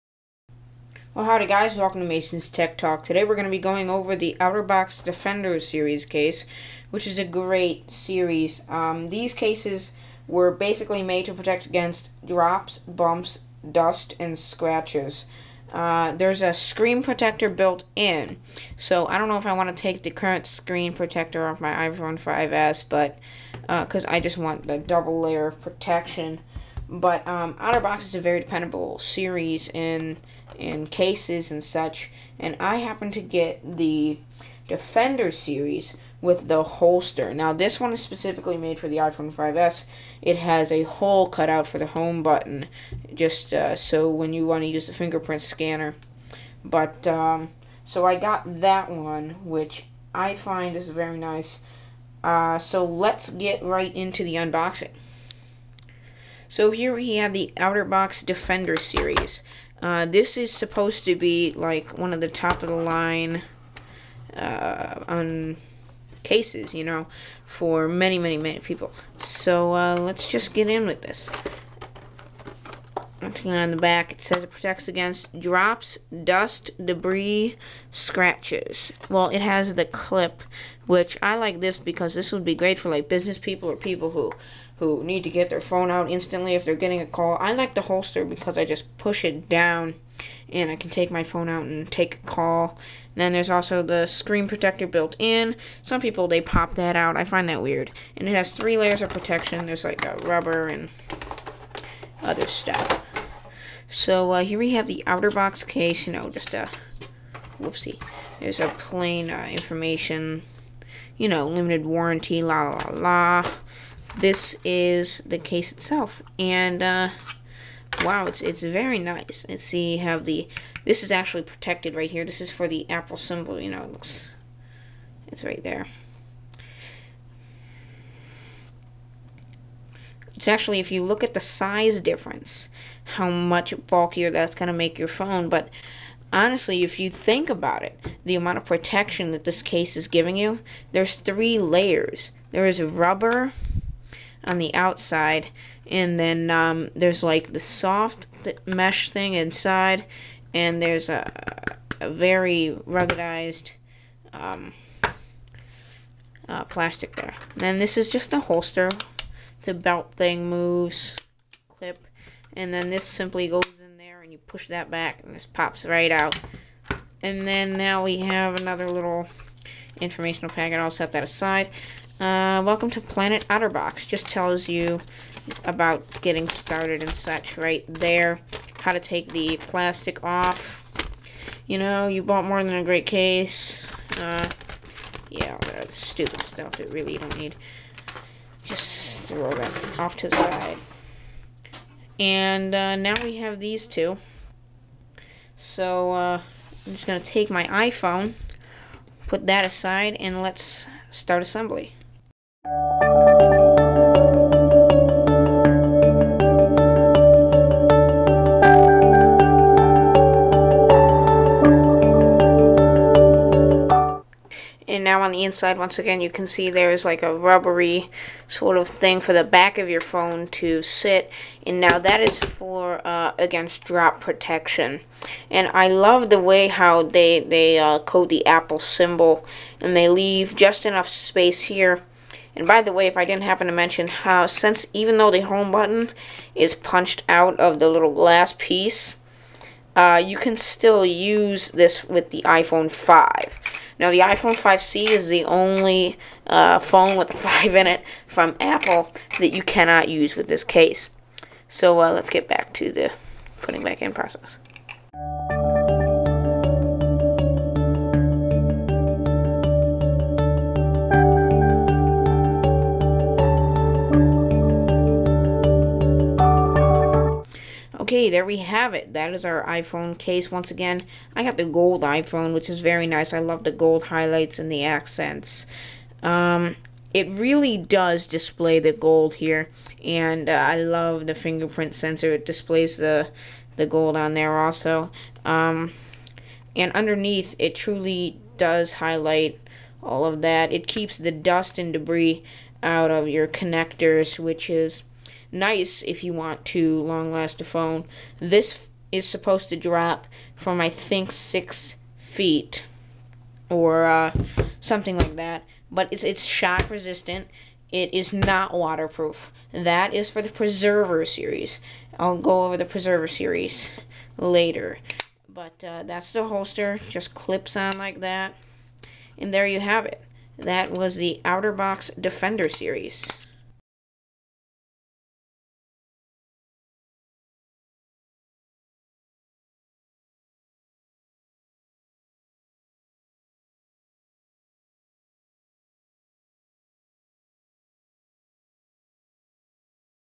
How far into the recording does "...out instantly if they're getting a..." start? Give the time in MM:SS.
01:25.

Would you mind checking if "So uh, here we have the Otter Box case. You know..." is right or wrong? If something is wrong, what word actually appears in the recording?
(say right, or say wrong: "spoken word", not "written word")
right.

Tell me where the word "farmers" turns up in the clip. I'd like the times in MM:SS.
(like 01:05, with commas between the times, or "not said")
not said.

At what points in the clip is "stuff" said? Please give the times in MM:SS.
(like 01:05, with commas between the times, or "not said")
01:42, 03:06.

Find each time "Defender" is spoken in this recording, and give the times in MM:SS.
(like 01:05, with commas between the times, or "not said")
00:05, 00:34, 00:58, 05:22.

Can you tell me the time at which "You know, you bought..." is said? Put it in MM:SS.
03:01.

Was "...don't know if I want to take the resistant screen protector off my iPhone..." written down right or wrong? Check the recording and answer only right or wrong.
wrong.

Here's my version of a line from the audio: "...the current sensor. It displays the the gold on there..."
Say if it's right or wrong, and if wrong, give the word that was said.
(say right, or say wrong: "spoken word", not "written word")
wrong: "fingerprint", not "current".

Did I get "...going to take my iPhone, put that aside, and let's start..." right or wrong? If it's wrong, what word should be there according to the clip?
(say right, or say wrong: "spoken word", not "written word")
right.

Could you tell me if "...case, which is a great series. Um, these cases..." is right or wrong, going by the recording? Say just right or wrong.
right.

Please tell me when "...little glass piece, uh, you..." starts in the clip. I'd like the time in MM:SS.
03:57.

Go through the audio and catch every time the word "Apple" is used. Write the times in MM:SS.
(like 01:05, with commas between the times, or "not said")
02:02, 03:48, 04:08.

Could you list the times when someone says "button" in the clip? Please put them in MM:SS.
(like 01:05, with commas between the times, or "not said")
00:42, 03:55.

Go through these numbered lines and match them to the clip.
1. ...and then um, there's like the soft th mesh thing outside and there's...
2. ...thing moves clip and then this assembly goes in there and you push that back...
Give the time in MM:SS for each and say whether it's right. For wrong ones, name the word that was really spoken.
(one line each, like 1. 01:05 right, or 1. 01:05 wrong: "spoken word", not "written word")
1. 02:25 wrong: "inside", not "outside"
2. 02:40 wrong: "simply", not "assembly".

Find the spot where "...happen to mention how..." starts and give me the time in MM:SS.
03:53.